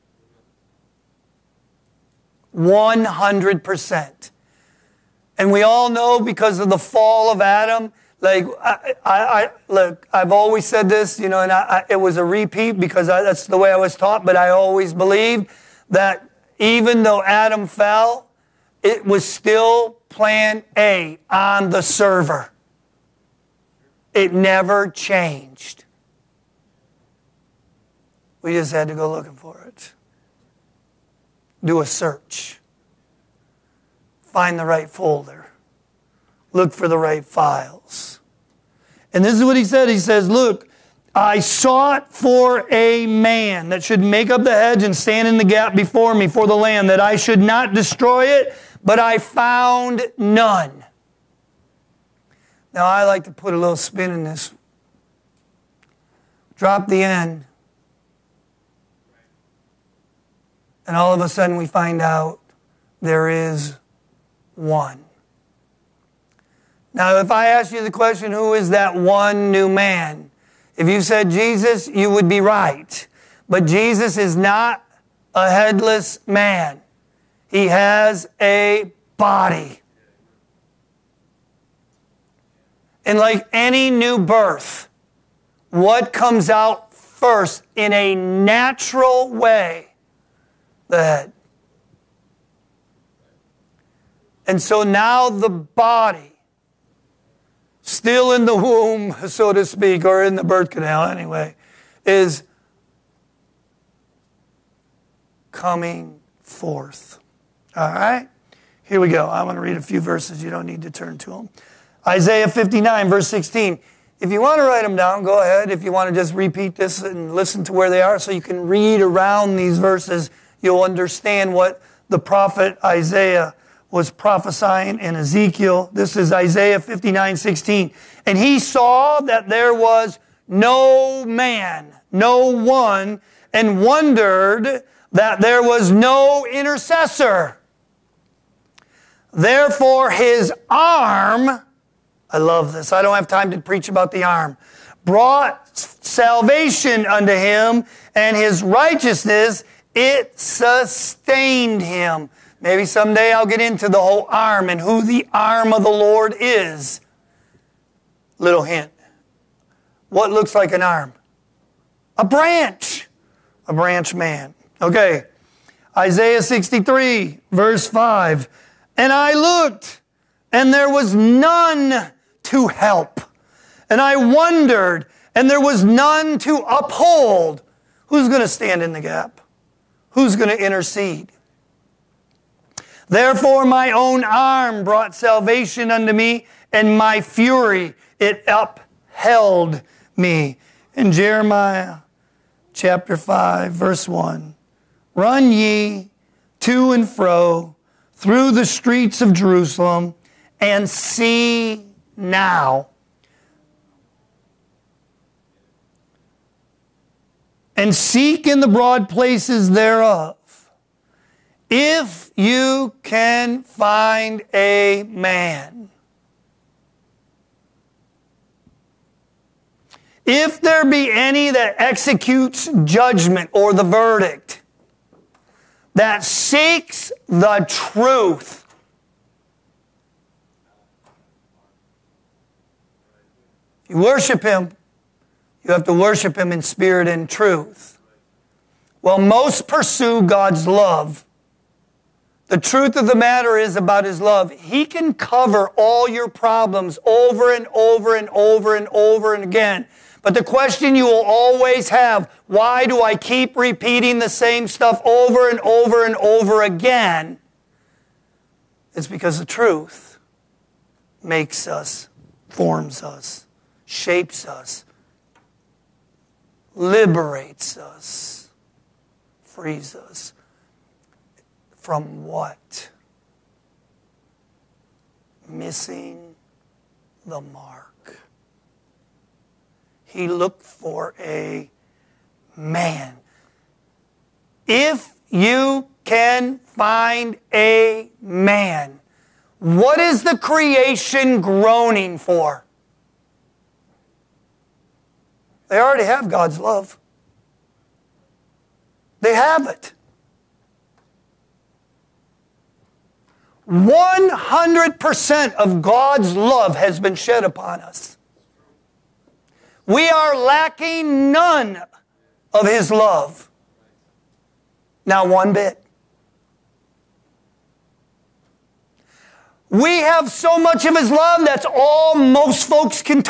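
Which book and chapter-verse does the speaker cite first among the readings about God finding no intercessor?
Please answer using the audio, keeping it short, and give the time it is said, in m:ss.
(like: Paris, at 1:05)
Isaiah 59:16, at 1:52.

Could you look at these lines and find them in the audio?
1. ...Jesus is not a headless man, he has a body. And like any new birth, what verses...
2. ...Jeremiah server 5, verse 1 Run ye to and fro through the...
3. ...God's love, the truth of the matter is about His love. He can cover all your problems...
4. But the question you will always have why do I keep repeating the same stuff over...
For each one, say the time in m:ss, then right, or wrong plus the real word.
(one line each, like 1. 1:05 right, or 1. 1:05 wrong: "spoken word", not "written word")
1. 1:13 wrong: "comes", not "verses"
2. 3:11 wrong: "chapter", not "server"
3. 4:00 right
4. 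4:10 right.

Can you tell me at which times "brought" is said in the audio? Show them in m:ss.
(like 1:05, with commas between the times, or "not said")
2:25, 3:04.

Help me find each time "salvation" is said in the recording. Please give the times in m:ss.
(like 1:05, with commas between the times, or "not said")
2:25, 3:05.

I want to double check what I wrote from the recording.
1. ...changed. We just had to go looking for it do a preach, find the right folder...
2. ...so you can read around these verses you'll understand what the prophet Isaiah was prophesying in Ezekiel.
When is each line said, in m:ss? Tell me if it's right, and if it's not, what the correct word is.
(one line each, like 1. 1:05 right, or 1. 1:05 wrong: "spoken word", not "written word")
1. 0:24 wrong: "search", not "preach"
2. 1:58 right.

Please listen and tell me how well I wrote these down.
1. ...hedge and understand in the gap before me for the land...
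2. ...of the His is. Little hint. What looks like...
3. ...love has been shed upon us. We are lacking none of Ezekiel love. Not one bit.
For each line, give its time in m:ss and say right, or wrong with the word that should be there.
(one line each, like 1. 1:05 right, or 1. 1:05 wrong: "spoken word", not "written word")
1. 0:44 wrong: "stand", not "understand"
2. 2:35 wrong: "Lord", not "His"
3. 5:06 wrong: "His", not "Ezekiel".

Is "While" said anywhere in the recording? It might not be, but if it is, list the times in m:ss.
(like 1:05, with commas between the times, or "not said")
3:59.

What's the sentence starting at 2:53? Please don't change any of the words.
And I wondered, and there was none to uphold.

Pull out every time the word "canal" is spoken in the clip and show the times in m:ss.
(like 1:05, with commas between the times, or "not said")
1:40.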